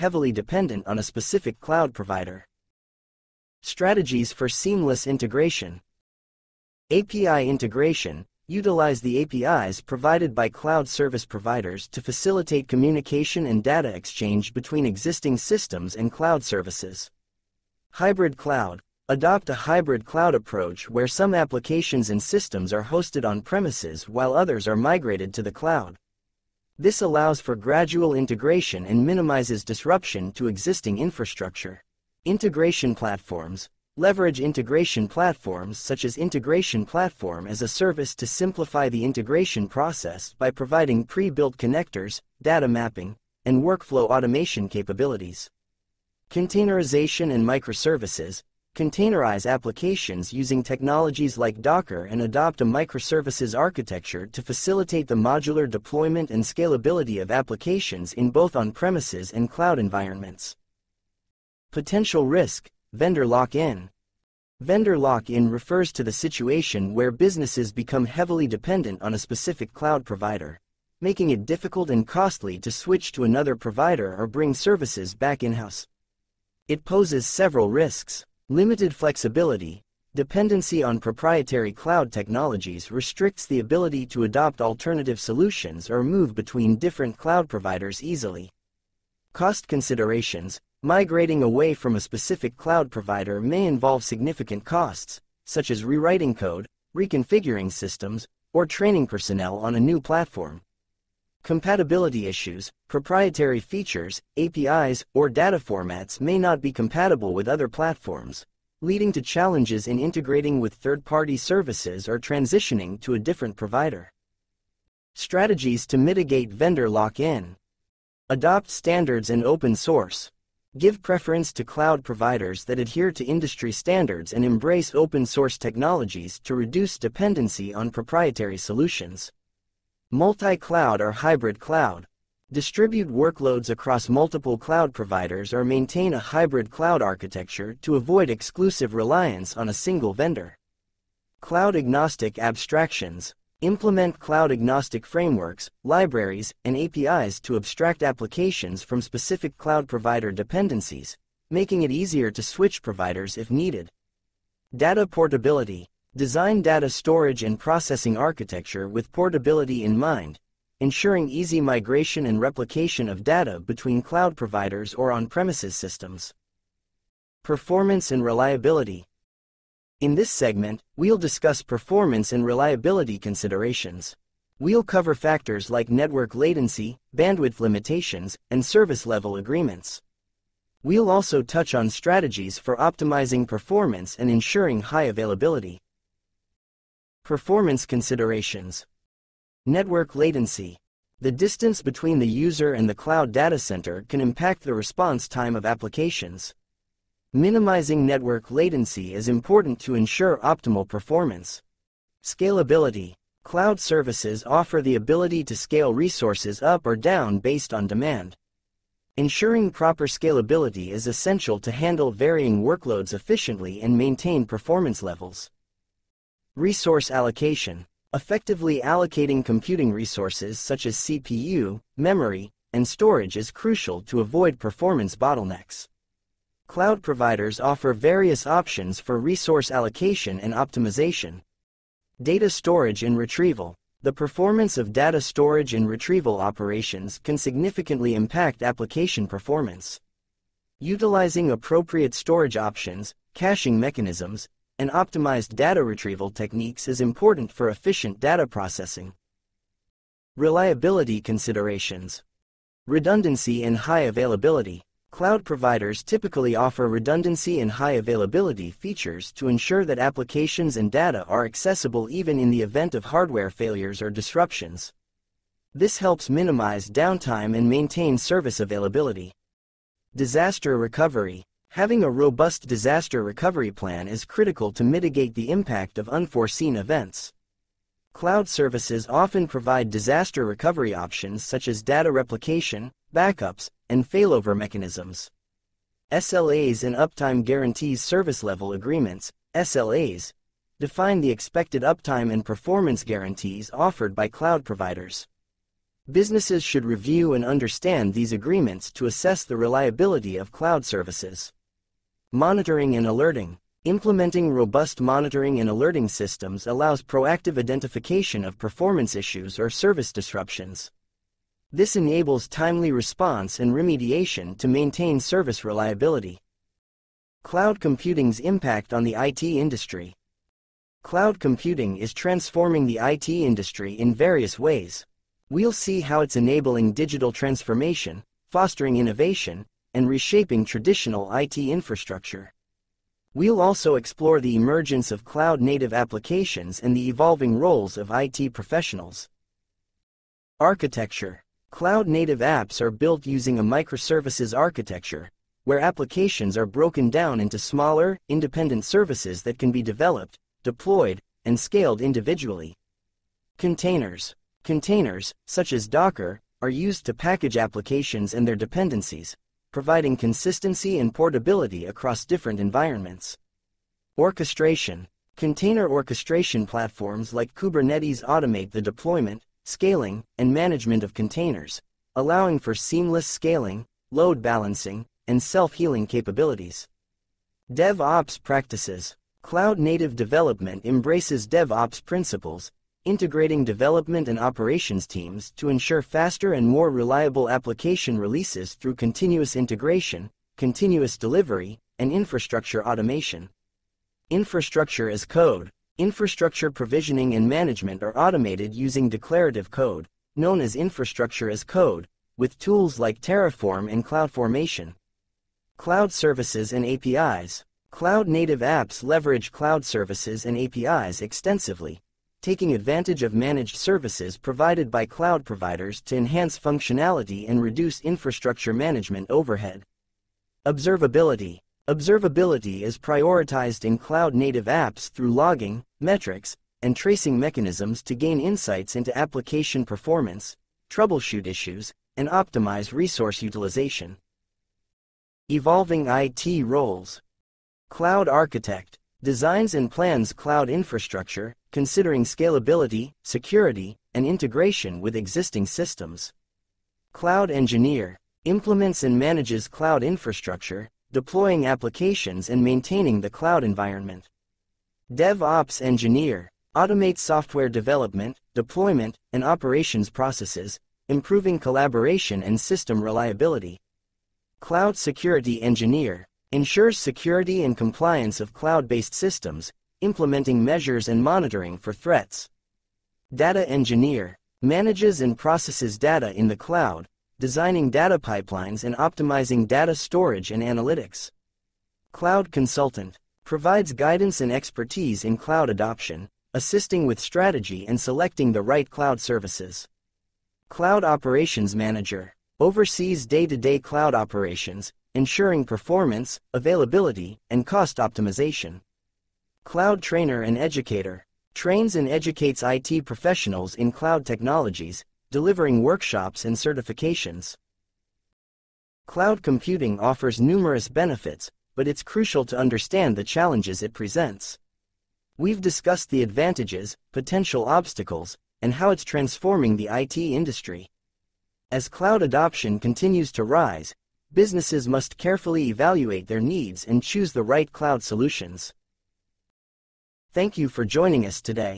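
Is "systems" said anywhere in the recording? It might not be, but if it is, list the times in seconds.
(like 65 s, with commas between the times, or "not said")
15 s, 22 s, 97 s, 165 s, 306 s, 445 s, 462 s, 469 s.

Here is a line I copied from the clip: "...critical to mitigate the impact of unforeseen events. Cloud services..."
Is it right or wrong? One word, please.
right.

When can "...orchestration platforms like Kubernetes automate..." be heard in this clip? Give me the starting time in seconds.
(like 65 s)
365 s.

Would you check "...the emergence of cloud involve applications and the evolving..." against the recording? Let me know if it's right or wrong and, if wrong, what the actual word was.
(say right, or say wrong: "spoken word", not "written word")
wrong: "native", not "involve".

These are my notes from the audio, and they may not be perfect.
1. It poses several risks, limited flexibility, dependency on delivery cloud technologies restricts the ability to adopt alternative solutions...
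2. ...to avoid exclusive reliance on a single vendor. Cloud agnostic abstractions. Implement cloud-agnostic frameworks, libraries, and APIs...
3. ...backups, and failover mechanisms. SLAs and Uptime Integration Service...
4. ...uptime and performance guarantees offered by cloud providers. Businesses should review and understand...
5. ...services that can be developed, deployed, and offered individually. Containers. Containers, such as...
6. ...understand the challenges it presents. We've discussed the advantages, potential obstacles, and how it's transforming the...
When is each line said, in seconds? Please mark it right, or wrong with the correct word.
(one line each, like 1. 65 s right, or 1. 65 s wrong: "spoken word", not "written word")
1. 76 s wrong: "proprietary", not "delivery"
2. 137 s right
3. 283 s wrong: "Guarantees", not "Integration"
4. 291 s right
5. 348 s wrong: "scaled", not "offered"
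6. 512 s right.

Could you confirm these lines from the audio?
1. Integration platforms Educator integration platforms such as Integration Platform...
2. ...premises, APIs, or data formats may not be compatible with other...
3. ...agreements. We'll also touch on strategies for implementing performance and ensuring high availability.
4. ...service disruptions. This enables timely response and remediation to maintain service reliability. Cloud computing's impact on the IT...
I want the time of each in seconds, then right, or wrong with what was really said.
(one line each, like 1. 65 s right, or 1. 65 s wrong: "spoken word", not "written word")
1. 32 s wrong: "Leverage", not "Educator"
2. 103 s wrong: "features", not "premises"
3. 179 s wrong: "optimizing", not "implementing"
4. 309 s right.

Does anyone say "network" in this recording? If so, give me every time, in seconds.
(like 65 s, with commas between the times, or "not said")
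175 s, 189 s, 198 s.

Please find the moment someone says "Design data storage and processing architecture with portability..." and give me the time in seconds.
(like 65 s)
156 s.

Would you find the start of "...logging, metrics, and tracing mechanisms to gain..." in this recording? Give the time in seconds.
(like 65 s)
425 s.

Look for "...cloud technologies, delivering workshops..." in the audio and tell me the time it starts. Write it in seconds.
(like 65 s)
503 s.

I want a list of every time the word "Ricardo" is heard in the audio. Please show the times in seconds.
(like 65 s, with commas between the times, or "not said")
not said.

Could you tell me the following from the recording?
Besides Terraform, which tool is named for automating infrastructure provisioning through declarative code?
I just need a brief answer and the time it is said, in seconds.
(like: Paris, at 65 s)
CloudFormation, at 404 s.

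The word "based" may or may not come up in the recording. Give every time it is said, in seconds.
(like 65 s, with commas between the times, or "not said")
207 s, 468 s.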